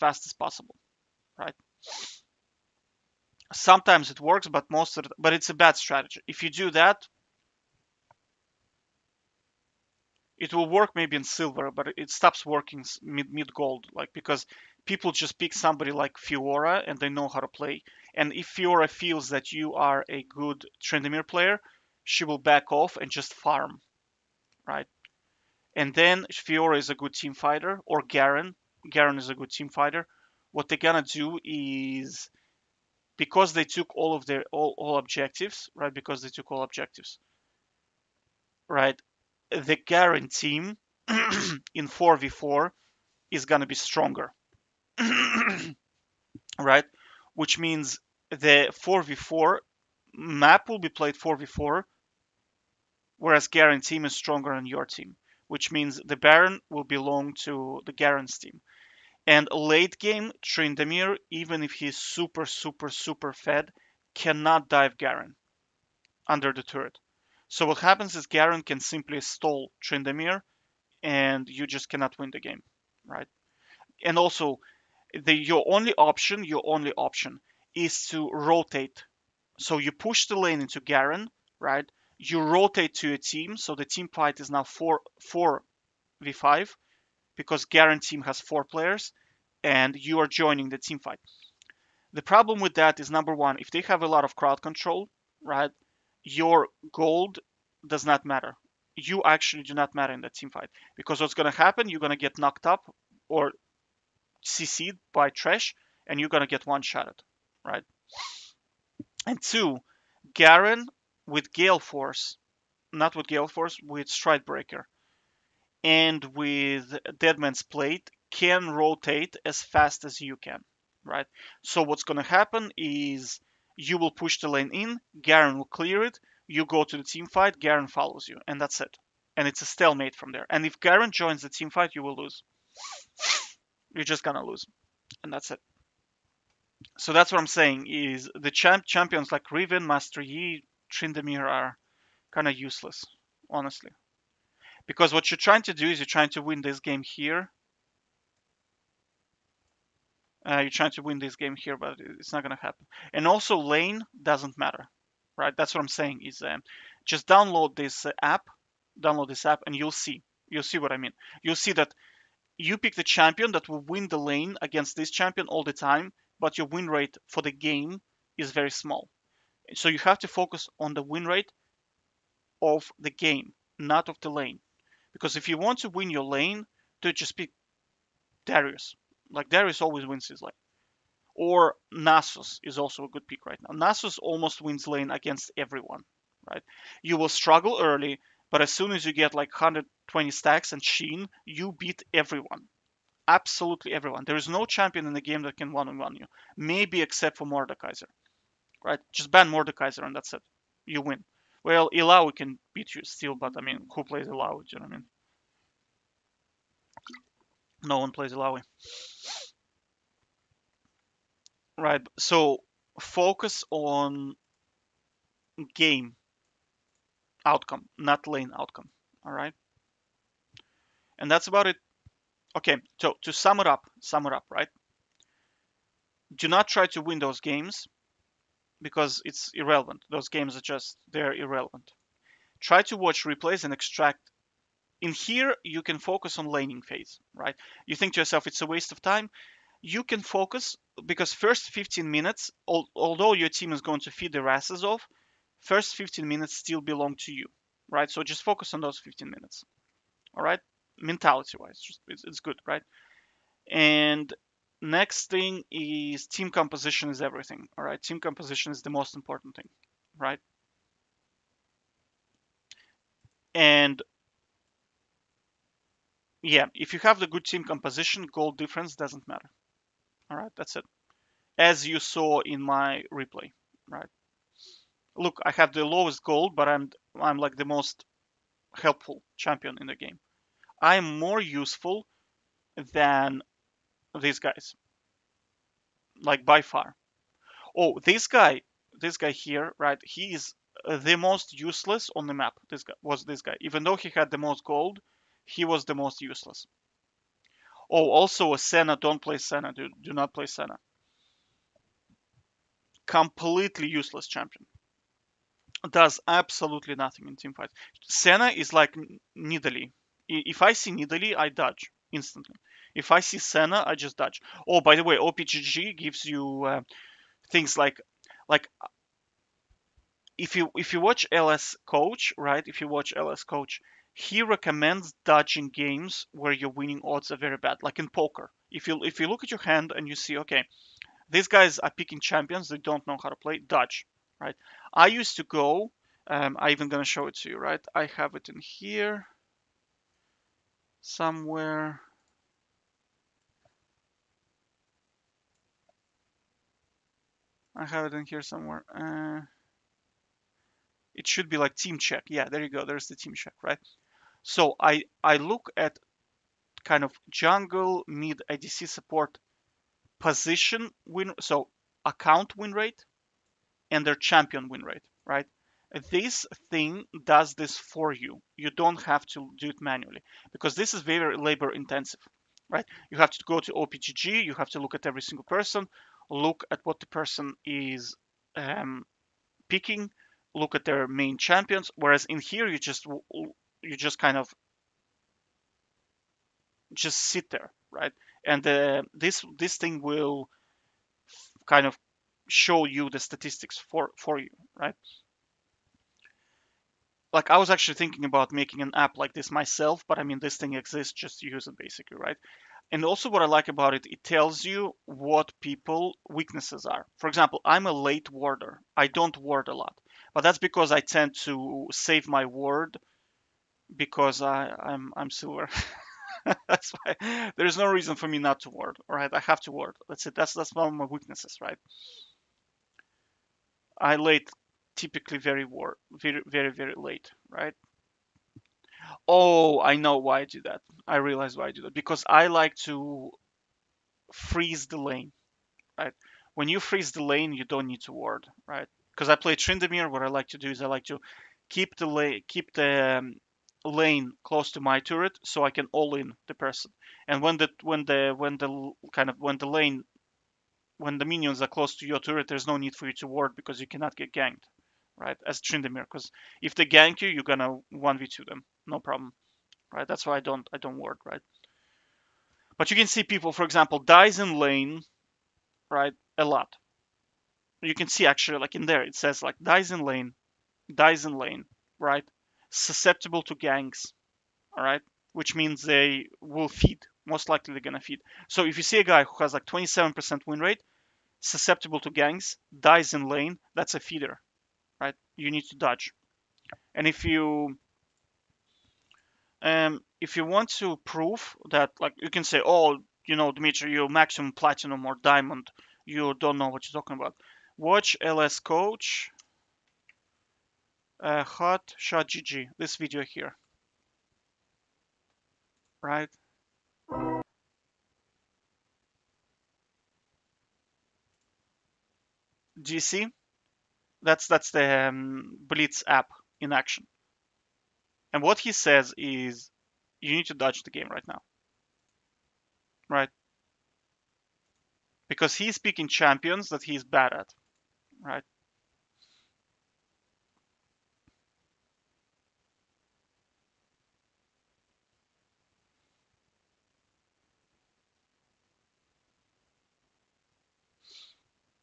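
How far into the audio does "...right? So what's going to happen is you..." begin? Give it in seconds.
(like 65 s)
121 s.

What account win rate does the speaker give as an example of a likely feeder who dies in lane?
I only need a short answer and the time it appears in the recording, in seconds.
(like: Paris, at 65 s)
27%, at 479 s.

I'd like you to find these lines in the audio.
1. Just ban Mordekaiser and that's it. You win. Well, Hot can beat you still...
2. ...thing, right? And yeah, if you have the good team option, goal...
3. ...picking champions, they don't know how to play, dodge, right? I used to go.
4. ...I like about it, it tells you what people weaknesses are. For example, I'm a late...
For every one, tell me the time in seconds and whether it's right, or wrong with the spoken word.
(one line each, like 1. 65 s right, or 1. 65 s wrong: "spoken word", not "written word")
1. 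199 s wrong: "Illaoi", not "Hot"
2. 259 s wrong: "composition", not "option"
3. 331 s right
4. 403 s right.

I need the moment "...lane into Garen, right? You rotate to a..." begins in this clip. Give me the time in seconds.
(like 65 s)
80 s.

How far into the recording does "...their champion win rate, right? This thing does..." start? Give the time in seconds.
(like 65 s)
364 s.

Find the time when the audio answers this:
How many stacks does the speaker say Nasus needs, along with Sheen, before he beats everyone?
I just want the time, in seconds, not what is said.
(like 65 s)
189 s.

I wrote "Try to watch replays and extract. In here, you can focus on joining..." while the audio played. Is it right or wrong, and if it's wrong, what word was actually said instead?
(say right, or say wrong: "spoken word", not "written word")
wrong: "laning", not "joining".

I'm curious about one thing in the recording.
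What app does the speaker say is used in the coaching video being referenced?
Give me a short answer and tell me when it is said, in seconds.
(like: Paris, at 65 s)
Blitz, at 515 s.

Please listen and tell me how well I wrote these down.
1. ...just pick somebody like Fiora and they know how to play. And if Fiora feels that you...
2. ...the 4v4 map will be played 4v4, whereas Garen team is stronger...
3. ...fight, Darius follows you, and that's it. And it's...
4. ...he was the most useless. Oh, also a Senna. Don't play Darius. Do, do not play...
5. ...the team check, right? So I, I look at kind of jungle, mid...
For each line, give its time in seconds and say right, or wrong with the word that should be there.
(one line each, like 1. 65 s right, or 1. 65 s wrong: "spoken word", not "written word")
1. 15 s right
2. 48 s right
3. 127 s wrong: "Garen", not "Darius"
4. 295 s wrong: "Senna", not "Darius"
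5. 353 s right.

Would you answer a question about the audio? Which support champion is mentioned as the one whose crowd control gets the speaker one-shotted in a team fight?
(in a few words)
Thresh.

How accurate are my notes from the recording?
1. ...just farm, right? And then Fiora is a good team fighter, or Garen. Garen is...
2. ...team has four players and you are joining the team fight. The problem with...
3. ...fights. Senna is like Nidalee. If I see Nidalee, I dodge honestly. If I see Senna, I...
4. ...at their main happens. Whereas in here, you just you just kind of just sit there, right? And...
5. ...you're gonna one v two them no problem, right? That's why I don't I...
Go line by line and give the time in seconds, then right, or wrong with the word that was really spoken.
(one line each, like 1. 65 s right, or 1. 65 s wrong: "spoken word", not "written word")
1. 23 s right
2. 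88 s right
3. 307 s wrong: "instantly", not "honestly"
4. 380 s wrong: "champions", not "happens"
5. 457 s right.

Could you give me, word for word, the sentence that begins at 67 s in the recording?
So what happens is Garen can simply stall Tryndamere and you just cannot win the game, right?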